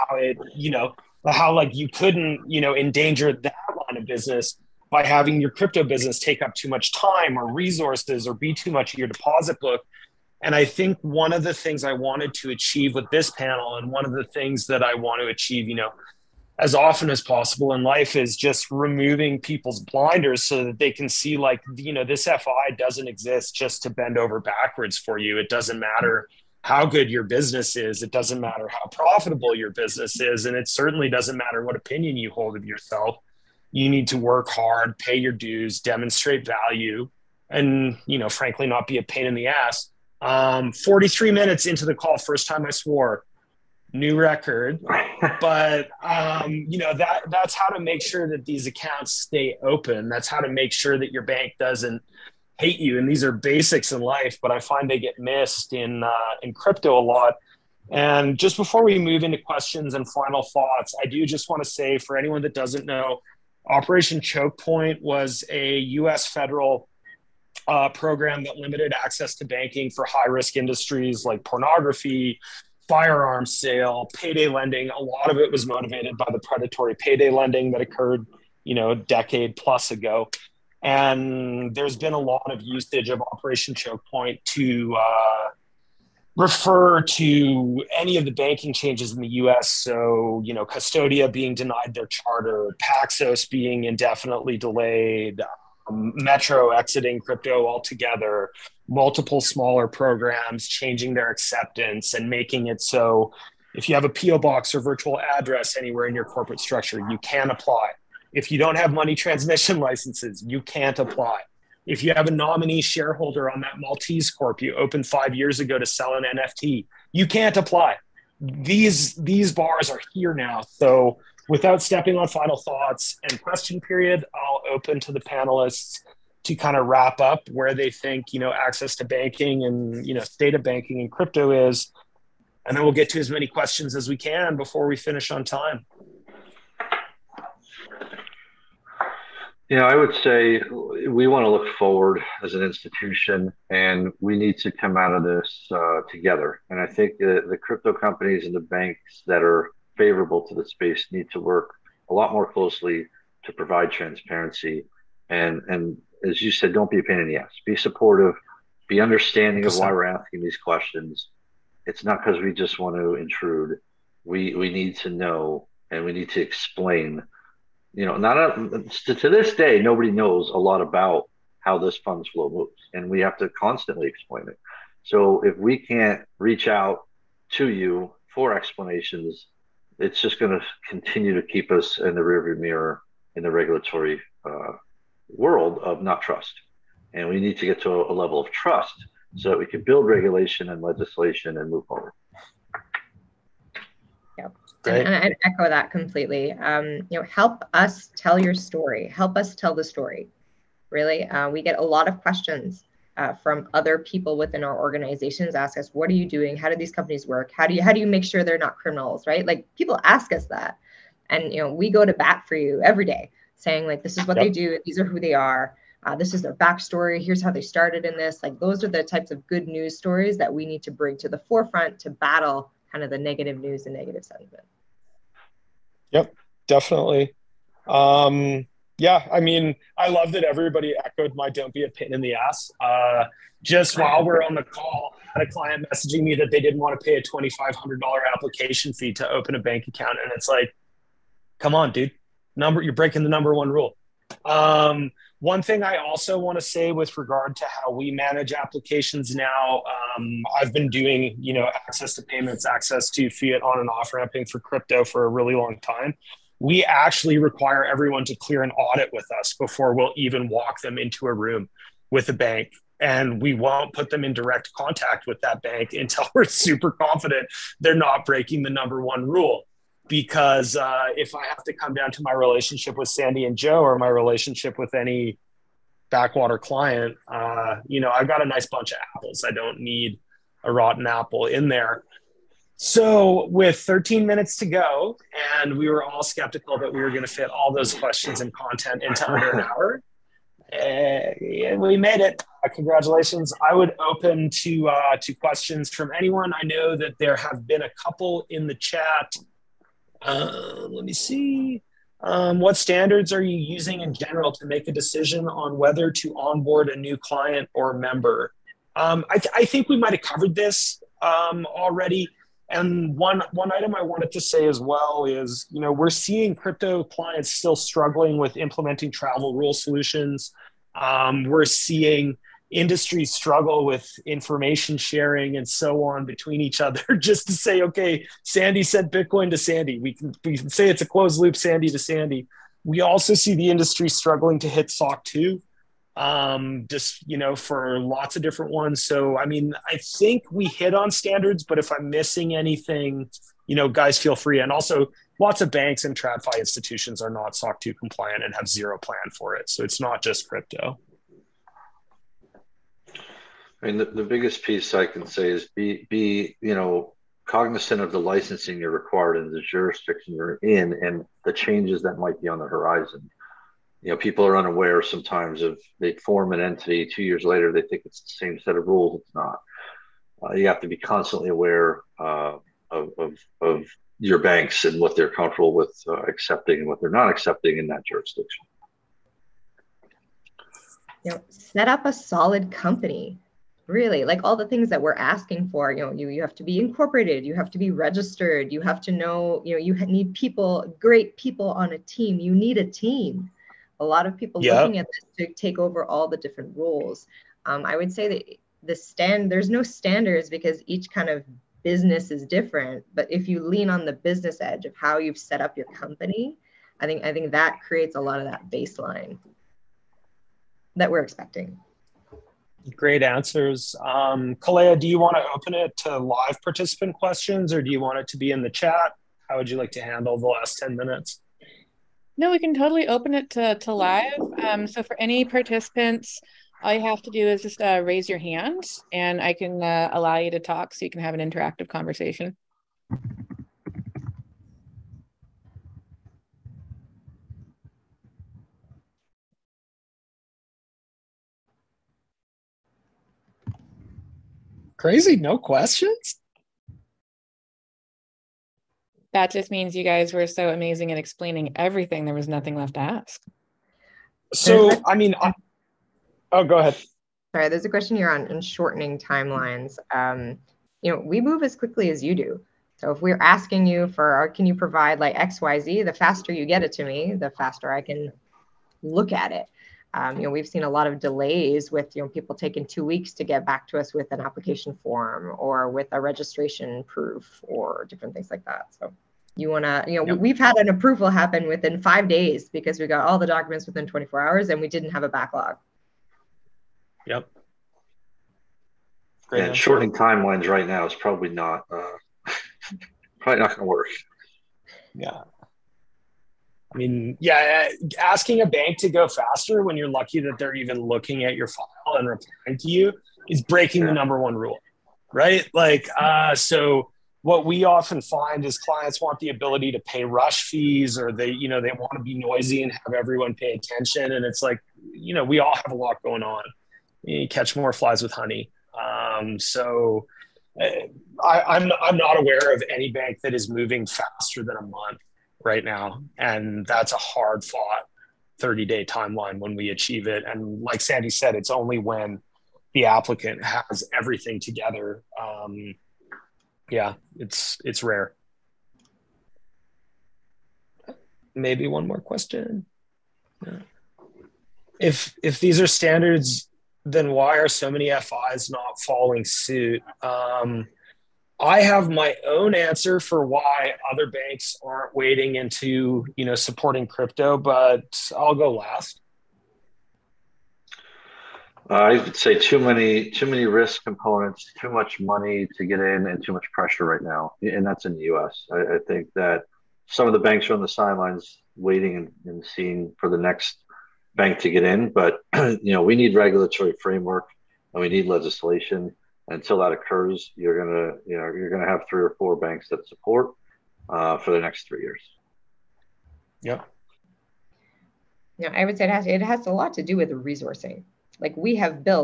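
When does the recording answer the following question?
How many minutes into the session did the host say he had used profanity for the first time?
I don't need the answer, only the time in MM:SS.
00:40.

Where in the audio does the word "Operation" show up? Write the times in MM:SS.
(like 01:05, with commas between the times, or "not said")
01:03, 01:23.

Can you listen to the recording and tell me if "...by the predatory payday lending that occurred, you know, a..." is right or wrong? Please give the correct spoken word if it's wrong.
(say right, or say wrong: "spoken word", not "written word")
right.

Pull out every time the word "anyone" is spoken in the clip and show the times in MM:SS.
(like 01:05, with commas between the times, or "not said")
01:02, 04:56.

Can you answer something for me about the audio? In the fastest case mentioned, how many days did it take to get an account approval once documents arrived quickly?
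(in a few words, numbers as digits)
5.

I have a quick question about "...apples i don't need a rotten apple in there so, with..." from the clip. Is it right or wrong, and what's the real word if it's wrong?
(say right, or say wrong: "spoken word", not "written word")
right.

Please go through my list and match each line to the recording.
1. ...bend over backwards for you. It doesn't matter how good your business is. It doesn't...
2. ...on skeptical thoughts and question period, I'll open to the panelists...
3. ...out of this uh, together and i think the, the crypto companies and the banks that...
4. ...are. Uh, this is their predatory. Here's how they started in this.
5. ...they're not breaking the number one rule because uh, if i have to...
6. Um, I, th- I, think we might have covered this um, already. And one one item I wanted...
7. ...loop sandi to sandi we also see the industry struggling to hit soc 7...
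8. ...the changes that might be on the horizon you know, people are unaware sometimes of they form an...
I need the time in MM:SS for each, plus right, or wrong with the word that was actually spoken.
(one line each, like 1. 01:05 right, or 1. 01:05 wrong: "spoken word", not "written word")
1. 00:23 right
2. 02:02 wrong: "final", not "skeptical"
3. 02:24 right
4. 03:35 wrong: "backstory", not "predatory"
5. 04:27 right
6. 05:08 right
7. 05:31 wrong: "2", not "7"
8. 06:01 right.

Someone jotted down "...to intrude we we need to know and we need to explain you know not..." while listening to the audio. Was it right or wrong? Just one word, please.
right.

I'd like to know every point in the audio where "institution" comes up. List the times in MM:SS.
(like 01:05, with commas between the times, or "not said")
02:22, 05:46.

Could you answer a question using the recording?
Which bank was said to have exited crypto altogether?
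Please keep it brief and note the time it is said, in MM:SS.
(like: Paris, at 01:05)
Metro, at 01:35.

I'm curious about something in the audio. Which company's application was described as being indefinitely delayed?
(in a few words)
Paxos.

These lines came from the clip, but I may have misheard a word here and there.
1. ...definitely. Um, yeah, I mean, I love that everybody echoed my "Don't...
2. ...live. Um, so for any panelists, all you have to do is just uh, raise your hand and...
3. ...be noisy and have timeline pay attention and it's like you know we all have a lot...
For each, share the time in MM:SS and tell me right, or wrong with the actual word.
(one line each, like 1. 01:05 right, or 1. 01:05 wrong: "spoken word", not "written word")
1. 03:46 right
2. 07:03 wrong: "participants", not "panelists"
3. 08:32 wrong: "everyone", not "timeline".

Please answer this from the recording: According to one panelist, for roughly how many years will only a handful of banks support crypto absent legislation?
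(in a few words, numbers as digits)
3.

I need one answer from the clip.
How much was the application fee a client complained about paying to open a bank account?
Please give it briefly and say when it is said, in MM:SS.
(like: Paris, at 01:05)
$2,500, at 03:57.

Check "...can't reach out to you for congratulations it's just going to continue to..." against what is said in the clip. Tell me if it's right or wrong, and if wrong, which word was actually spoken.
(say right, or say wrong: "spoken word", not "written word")
wrong: "explanations", not "congratulations".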